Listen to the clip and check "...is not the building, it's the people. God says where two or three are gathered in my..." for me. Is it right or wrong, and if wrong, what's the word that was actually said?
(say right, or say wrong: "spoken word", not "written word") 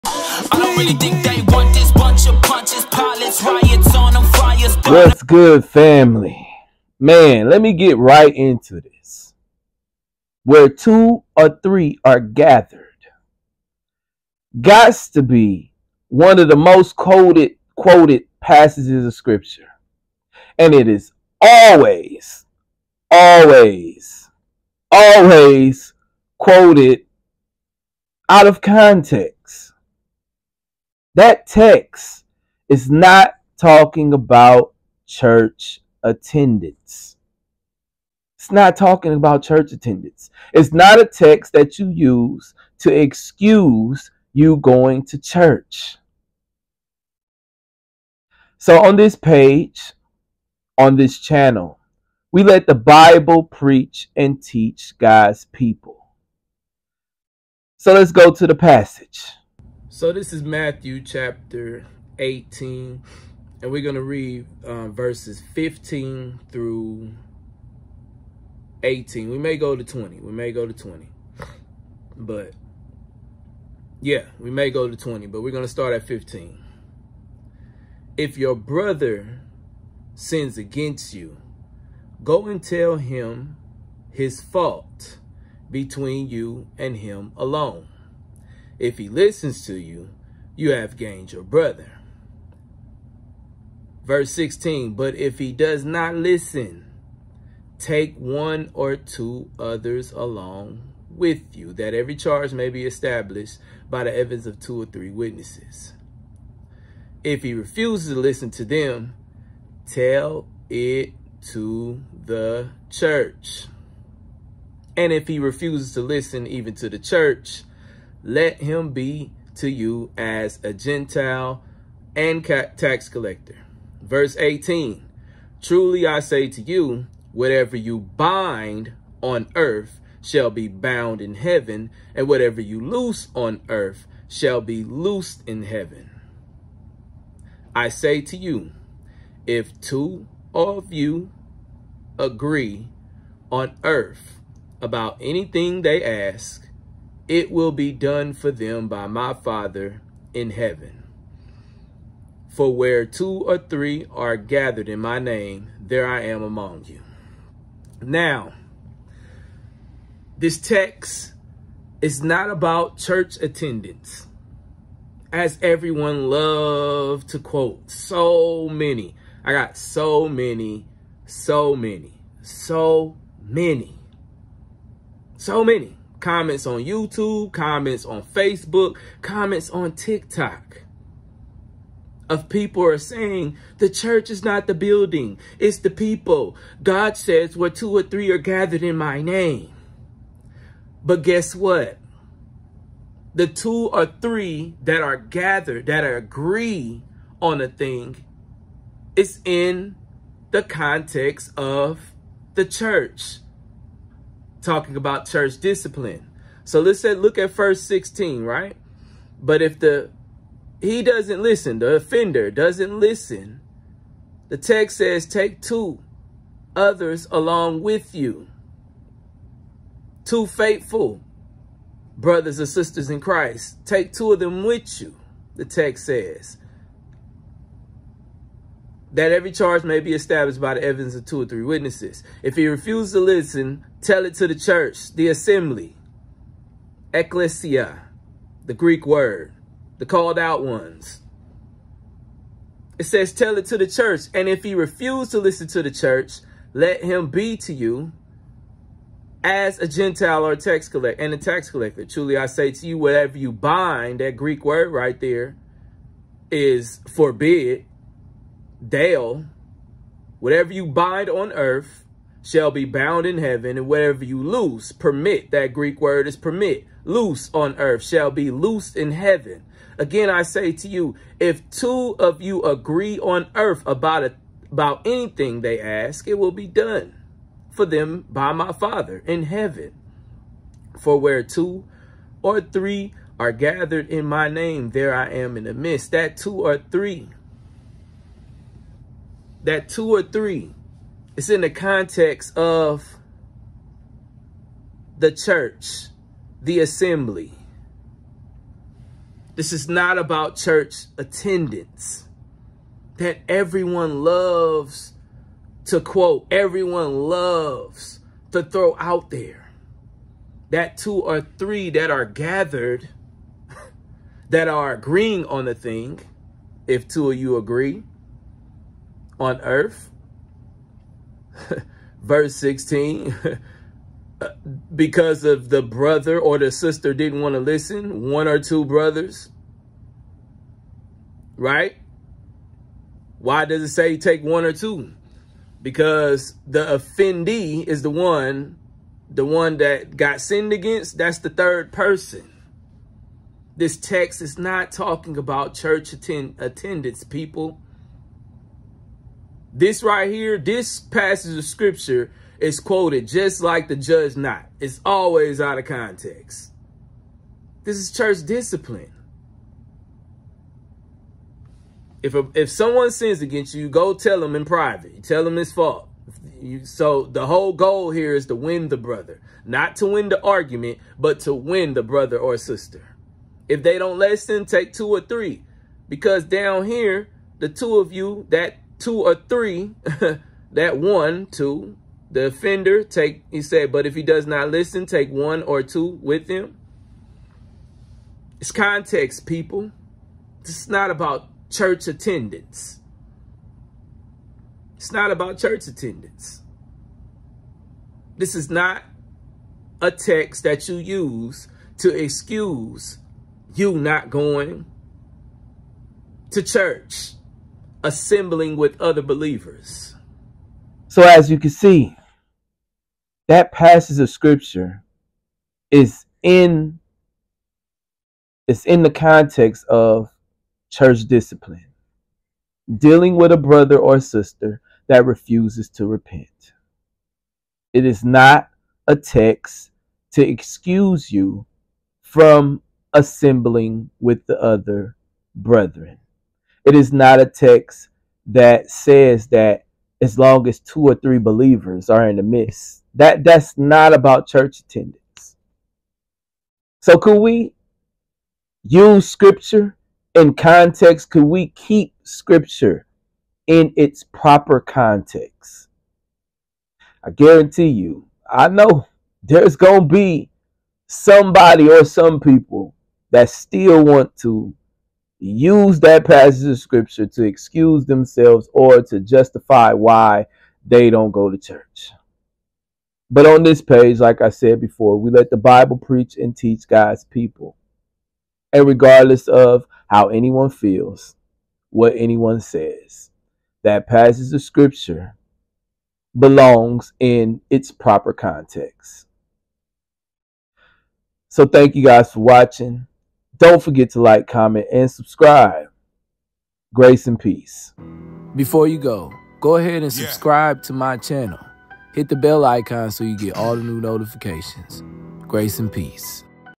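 right.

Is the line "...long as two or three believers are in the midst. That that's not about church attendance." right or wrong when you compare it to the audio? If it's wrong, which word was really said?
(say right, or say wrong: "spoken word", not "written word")
right.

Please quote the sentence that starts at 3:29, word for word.
But if the he doesn't listen, the offender doesn't listen, the text says, take two others along with you.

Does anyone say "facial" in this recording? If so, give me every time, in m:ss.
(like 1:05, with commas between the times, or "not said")
not said.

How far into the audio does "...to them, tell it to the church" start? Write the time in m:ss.
1:48.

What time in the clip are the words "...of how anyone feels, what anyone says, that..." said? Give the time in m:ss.
7:59.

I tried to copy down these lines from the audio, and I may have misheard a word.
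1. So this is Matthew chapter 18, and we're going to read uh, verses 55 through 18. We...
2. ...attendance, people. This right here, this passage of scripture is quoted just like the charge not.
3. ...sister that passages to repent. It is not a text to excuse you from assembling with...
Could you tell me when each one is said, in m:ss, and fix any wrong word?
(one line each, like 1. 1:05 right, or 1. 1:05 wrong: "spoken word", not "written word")
1. 1:00 wrong: "15", not "55"
2. 5:46 wrong: "judge", not "charge"
3. 7:04 wrong: "refuses", not "passages".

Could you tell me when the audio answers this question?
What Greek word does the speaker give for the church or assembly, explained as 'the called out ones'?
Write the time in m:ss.
3:57.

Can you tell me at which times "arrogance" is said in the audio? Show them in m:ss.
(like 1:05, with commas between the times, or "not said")
not said.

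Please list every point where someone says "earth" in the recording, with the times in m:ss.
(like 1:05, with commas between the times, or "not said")
2:09, 2:13, 2:23, 4:21, 4:27, 4:33, 5:19.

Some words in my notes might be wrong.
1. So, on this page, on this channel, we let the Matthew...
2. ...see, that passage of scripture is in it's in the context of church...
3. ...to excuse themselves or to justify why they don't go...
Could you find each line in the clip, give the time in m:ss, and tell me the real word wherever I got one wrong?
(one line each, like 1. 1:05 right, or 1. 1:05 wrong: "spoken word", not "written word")
1. 0:48 wrong: "Bible", not "Matthew"
2. 6:51 right
3. 7:47 right.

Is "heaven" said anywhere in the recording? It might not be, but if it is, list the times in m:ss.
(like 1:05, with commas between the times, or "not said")
2:11, 2:15, 2:30, 4:23, 4:29, 4:39.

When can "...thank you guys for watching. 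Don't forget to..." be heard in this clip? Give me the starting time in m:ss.
8:11.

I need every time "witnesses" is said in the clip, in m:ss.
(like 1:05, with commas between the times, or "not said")
1:45, 3:51.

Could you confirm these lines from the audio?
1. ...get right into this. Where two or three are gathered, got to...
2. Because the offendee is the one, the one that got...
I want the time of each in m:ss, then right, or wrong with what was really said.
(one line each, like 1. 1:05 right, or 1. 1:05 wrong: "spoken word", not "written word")
1. 0:07 right
2. 5:35 right.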